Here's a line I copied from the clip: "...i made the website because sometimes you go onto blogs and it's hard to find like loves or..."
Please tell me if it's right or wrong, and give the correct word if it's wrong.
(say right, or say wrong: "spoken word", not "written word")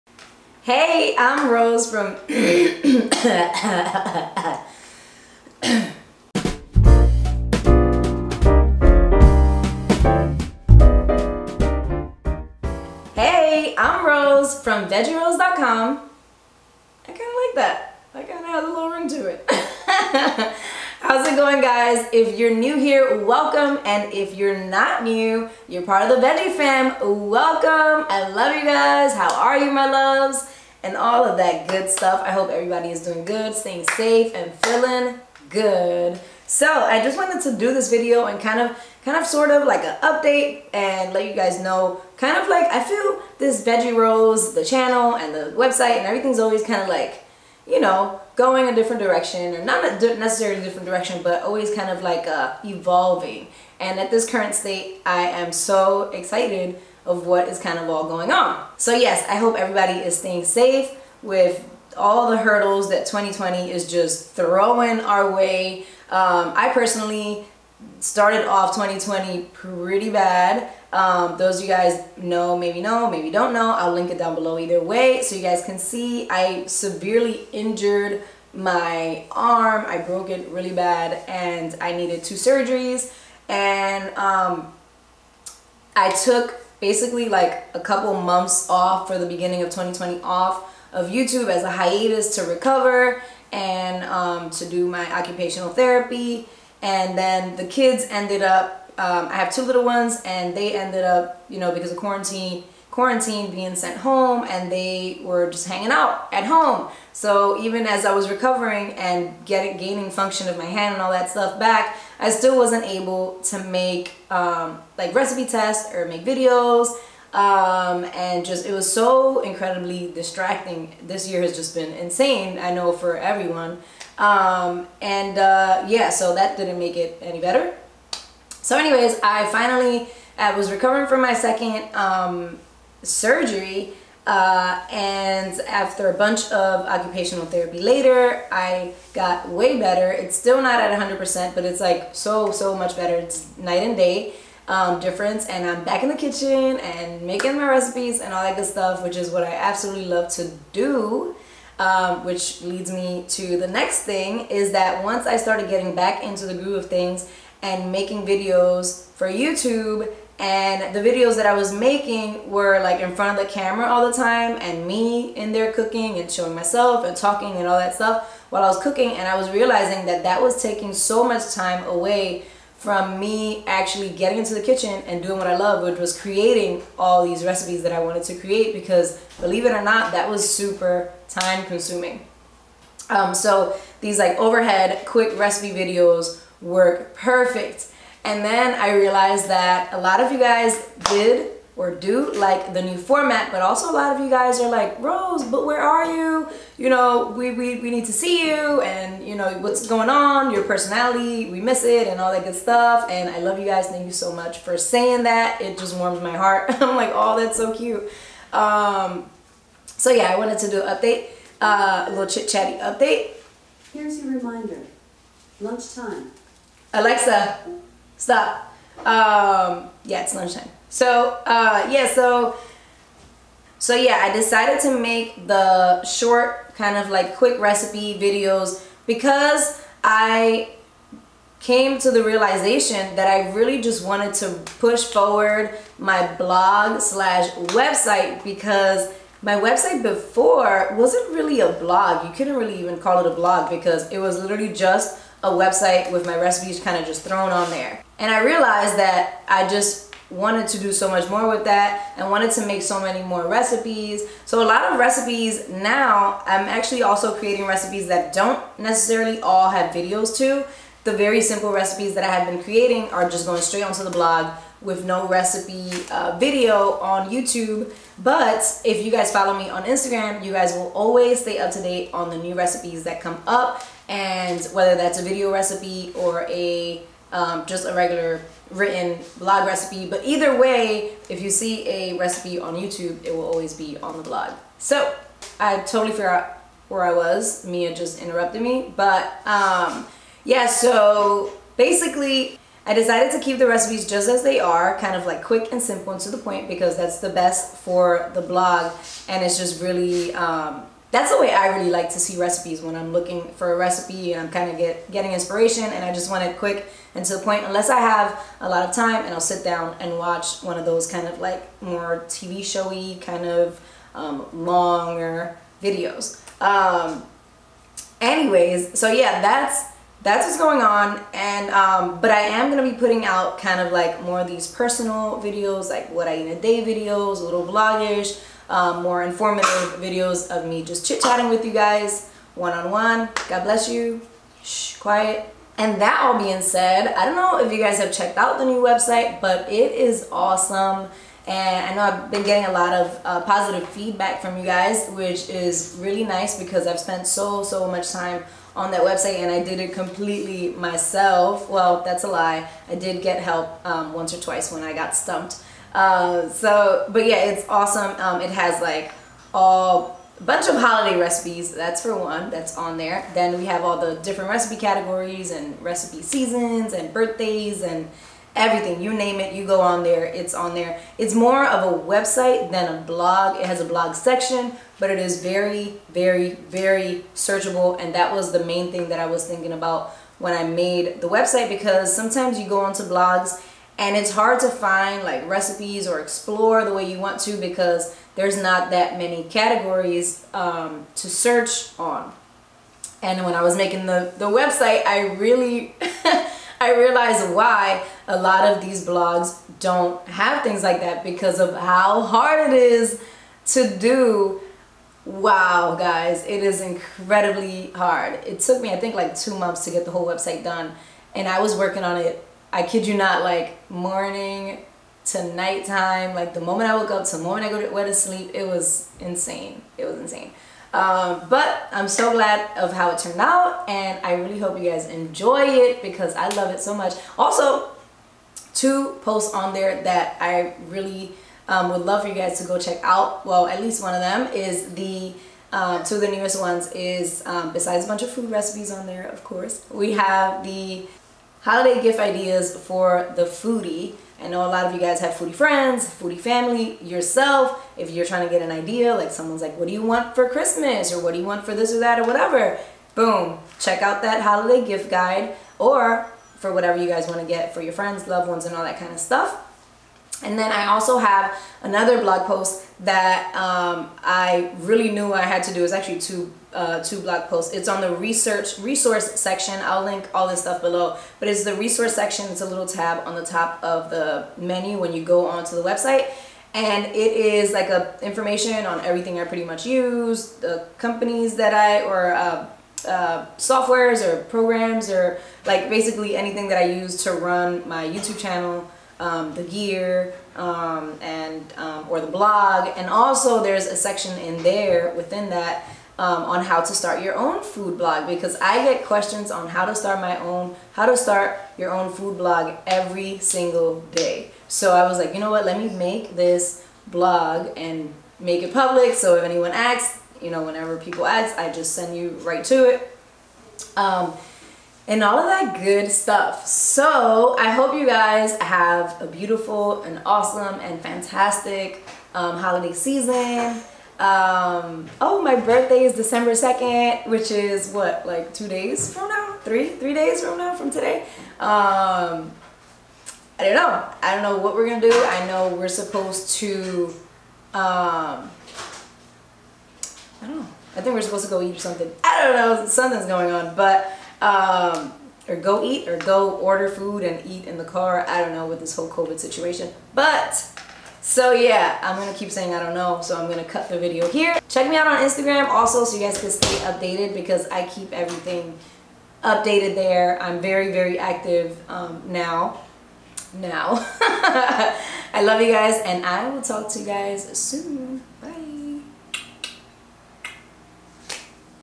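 wrong: "recipes", not "loves".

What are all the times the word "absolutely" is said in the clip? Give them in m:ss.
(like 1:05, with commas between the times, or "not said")
2:29.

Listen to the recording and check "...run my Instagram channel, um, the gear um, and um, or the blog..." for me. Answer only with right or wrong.
wrong.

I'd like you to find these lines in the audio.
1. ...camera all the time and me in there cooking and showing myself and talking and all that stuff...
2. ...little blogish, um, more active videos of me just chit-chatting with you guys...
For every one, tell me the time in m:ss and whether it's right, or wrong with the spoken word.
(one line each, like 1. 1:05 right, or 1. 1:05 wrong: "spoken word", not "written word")
1. 2:43 right
2. 5:27 wrong: "informative", not "active".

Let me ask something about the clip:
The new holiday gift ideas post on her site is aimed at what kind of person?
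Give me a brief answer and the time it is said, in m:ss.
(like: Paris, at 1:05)
The foodie, at 7:23.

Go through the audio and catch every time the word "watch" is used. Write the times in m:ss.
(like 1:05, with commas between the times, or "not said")
5:10.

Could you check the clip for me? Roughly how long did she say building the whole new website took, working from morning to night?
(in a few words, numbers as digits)
2 months.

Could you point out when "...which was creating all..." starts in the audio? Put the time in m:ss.
2:55.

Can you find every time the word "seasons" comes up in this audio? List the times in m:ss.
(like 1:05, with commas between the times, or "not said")
6:06, 8:42.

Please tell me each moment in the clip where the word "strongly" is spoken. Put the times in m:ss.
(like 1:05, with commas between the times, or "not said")
not said.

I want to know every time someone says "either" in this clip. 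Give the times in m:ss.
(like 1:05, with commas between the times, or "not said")
1:14, 4:40.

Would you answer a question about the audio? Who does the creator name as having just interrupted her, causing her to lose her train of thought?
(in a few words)
Mia.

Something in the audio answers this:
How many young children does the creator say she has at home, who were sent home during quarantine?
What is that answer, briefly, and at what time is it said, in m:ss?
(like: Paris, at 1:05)
2, at 1:39.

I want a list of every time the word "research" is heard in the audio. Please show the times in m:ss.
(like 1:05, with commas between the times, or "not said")
7:48.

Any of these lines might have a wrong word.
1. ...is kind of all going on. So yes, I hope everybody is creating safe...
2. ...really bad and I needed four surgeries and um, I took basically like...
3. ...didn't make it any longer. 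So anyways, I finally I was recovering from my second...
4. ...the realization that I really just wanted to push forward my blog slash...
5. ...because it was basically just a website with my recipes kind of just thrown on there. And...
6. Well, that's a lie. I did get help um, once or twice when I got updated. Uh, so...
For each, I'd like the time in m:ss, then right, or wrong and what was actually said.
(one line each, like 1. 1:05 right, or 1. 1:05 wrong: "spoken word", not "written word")
1. 0:57 wrong: "staying", not "creating"
2. 1:20 wrong: "two", not "four"
3. 2:06 wrong: "better", not "longer"
4. 3:52 right
5. 4:03 wrong: "literally", not "basically"
6. 5:51 wrong: "stumped", not "updated".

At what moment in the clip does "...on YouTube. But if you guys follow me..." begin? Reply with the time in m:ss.
4:26.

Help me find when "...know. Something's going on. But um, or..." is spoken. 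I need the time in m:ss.
9:02.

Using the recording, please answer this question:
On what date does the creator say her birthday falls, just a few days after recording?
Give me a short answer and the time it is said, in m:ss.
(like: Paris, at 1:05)
December 2, at 8:46.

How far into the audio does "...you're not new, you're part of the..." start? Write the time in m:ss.
0:24.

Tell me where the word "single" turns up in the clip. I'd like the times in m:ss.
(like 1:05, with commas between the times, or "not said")
8:23.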